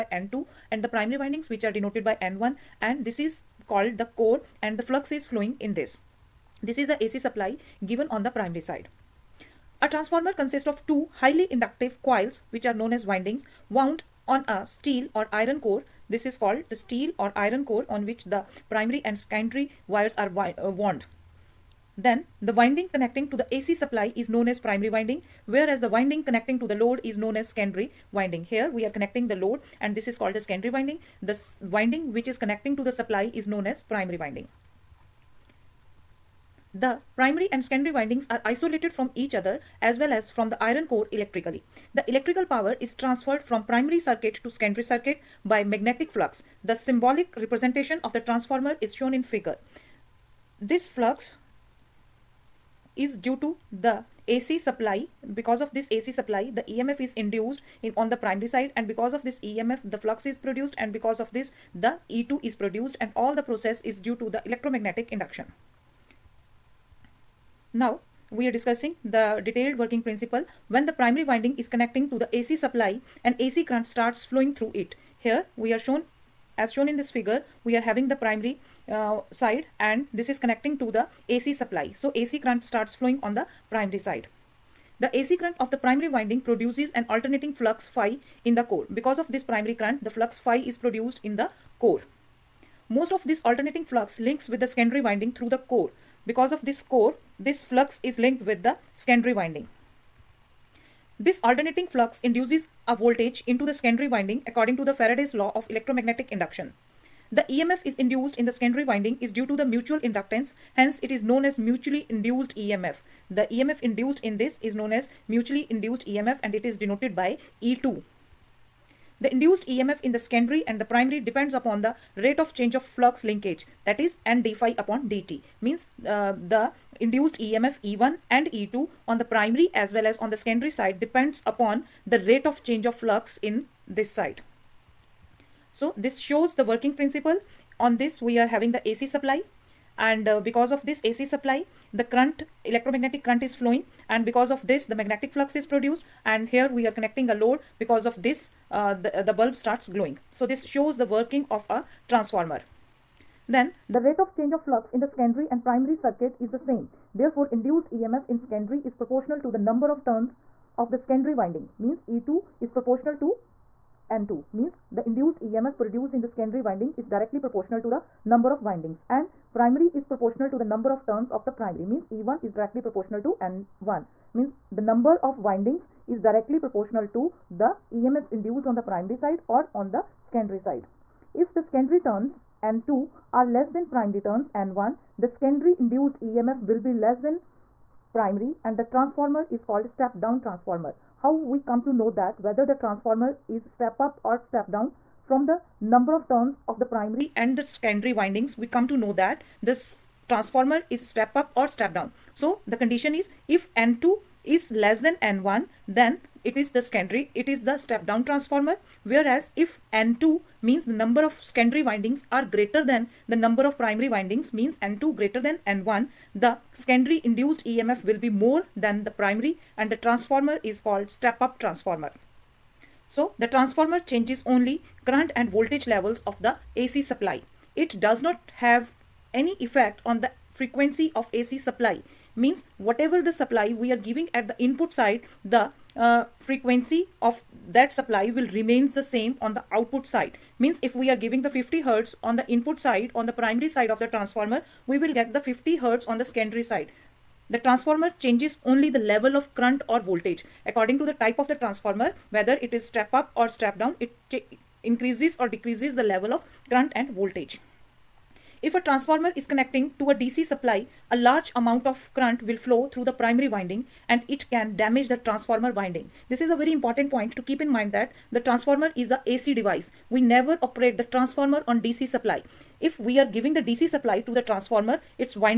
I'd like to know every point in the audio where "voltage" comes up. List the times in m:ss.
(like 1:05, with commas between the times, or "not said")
1:42, 3:45, 4:09, 4:17.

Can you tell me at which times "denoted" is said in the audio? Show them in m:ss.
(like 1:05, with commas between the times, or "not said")
0:01, 1:56.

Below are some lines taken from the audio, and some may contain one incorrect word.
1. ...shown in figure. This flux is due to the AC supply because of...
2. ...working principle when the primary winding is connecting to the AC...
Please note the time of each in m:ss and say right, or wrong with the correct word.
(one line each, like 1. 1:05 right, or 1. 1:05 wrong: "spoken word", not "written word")
1. 0:48 right
2. 1:09 right.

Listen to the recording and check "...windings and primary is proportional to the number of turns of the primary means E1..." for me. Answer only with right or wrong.
right.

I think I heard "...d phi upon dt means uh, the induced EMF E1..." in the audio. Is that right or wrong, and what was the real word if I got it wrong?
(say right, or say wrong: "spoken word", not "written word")
right.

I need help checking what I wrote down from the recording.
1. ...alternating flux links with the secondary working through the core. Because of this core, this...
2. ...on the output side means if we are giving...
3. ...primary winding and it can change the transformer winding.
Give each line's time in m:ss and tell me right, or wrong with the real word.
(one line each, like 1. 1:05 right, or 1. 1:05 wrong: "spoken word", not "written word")
1. 1:33 wrong: "winding", not "working"
2. 3:59 right
3. 4:23 wrong: "damage", not "change".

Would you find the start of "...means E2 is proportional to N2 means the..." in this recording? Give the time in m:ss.
2:41.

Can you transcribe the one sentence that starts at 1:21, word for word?
So AC current starts flowing on the primary side.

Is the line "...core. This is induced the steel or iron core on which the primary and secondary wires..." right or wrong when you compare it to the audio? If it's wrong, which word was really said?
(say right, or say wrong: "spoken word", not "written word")
wrong: "called", not "induced".